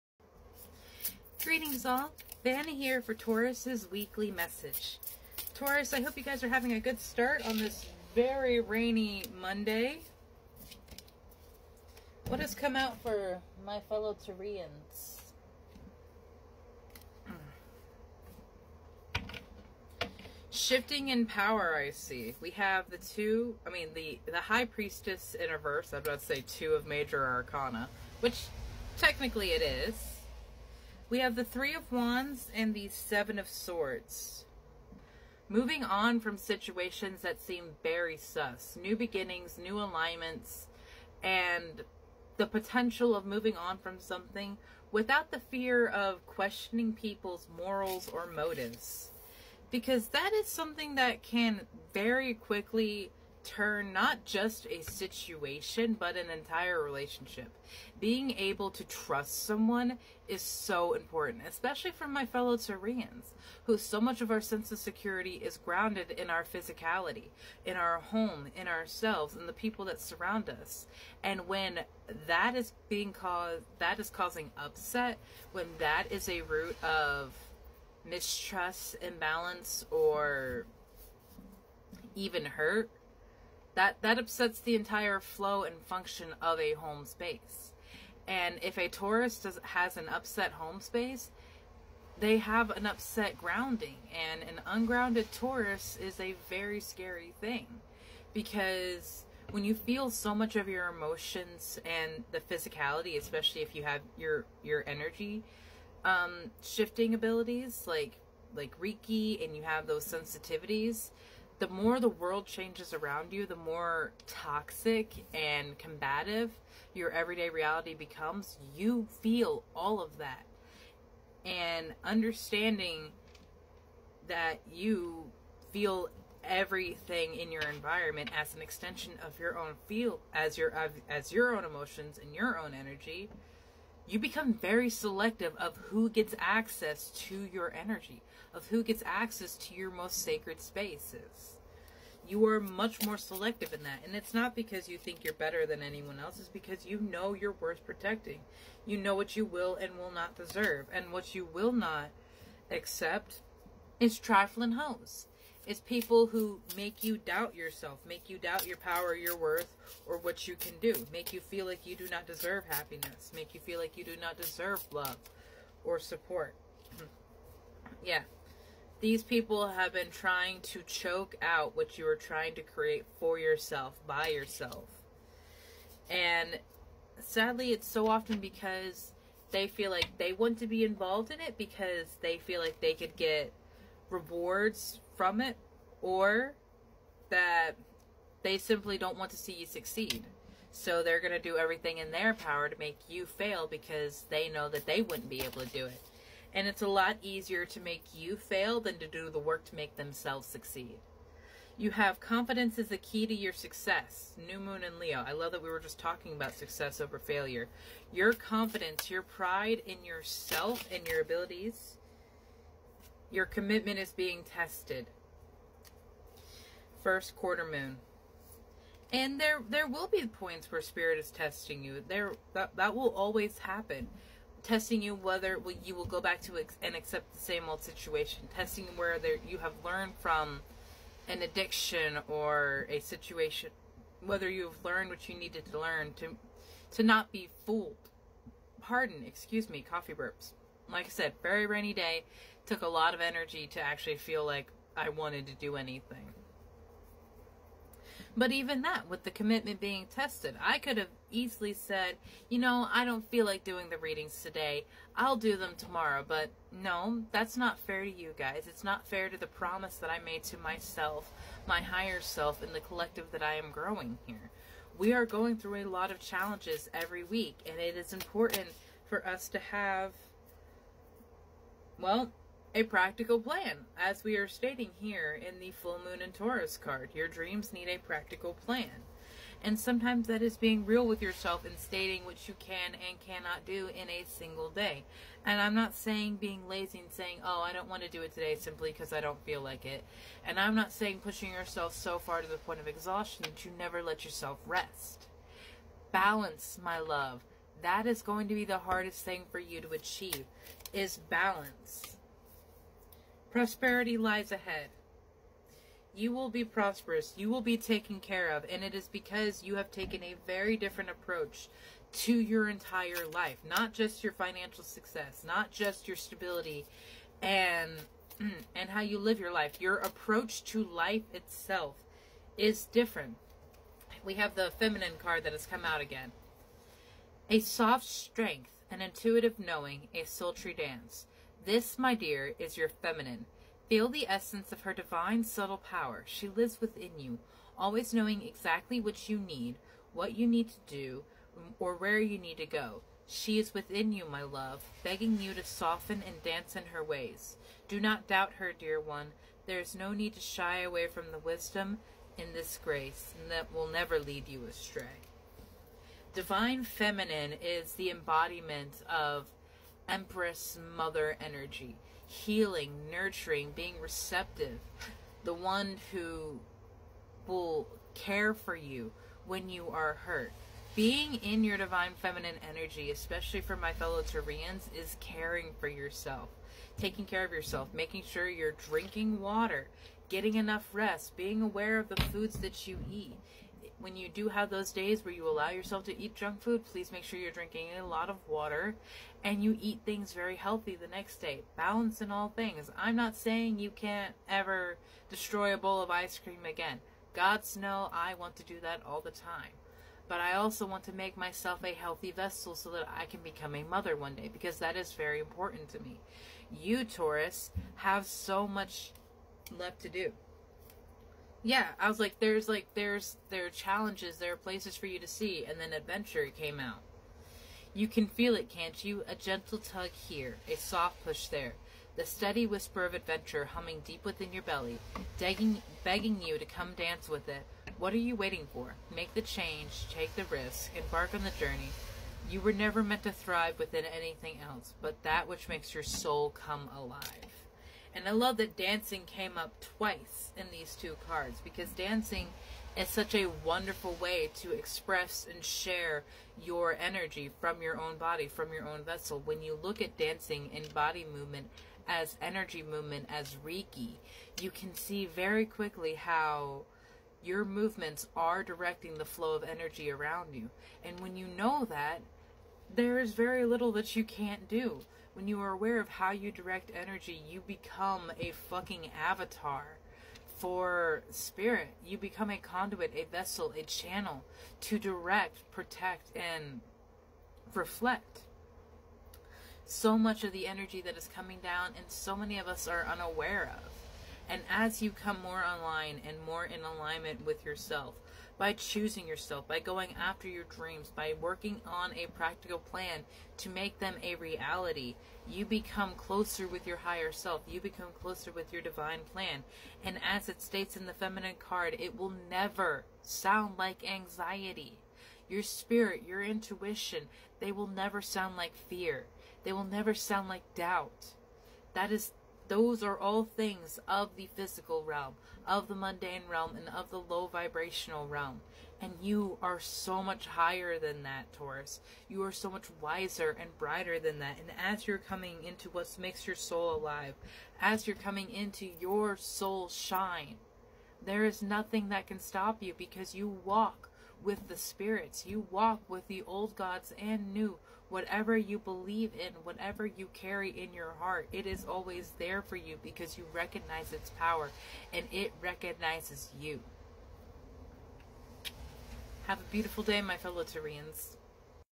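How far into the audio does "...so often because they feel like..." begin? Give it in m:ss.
2:57.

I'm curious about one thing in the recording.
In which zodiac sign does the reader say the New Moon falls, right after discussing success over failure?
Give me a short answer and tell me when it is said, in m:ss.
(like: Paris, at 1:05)
Leo, at 3:24.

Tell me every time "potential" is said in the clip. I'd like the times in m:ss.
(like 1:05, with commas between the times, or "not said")
0:42.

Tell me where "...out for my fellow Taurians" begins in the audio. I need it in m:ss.
0:12.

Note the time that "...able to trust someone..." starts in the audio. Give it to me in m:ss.
0:58.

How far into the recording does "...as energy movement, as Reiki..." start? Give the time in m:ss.
7:32.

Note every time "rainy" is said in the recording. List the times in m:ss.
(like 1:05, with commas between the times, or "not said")
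0:08, 4:01.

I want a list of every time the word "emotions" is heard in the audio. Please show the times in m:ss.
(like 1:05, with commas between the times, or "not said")
1:40, 2:11.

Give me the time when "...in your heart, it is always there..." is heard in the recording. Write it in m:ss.
9:00.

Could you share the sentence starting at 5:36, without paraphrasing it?
She lives within you, always knowing exactly what you need, what you need to do, or where you need to go.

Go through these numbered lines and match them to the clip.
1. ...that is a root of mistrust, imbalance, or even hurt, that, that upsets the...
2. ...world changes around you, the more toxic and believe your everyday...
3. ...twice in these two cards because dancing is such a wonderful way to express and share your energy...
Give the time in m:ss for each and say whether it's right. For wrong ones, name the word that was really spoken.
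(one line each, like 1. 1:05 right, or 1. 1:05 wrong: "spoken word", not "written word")
1. 1:15 right
2. 1:52 wrong: "combative", not "believe"
3. 7:19 right.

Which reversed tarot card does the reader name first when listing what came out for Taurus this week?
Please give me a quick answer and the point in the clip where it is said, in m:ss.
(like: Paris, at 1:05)
High Priestess, at 0:24.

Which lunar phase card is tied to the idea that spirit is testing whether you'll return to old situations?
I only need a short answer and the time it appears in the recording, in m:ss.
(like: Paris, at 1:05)
First quarter moon, at 3:37.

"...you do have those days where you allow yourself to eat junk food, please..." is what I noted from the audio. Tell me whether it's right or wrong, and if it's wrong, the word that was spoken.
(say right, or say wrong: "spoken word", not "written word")
right.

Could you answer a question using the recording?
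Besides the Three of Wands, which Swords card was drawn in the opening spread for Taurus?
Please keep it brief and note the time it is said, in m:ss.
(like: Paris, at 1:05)
Seven of Swords, at 0:32.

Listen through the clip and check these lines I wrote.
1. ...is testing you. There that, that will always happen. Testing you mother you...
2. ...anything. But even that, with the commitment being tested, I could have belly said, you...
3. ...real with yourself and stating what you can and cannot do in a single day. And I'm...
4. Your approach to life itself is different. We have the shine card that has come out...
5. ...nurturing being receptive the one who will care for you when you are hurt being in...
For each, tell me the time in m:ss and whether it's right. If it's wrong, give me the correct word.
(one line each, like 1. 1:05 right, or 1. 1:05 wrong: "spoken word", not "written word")
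1. 3:41 wrong: "whether", not "mother"
2. 4:05 wrong: "easily", not "belly"
3. 4:40 right
4. 5:19 wrong: "feminine", not "shine"
5. 6:03 right.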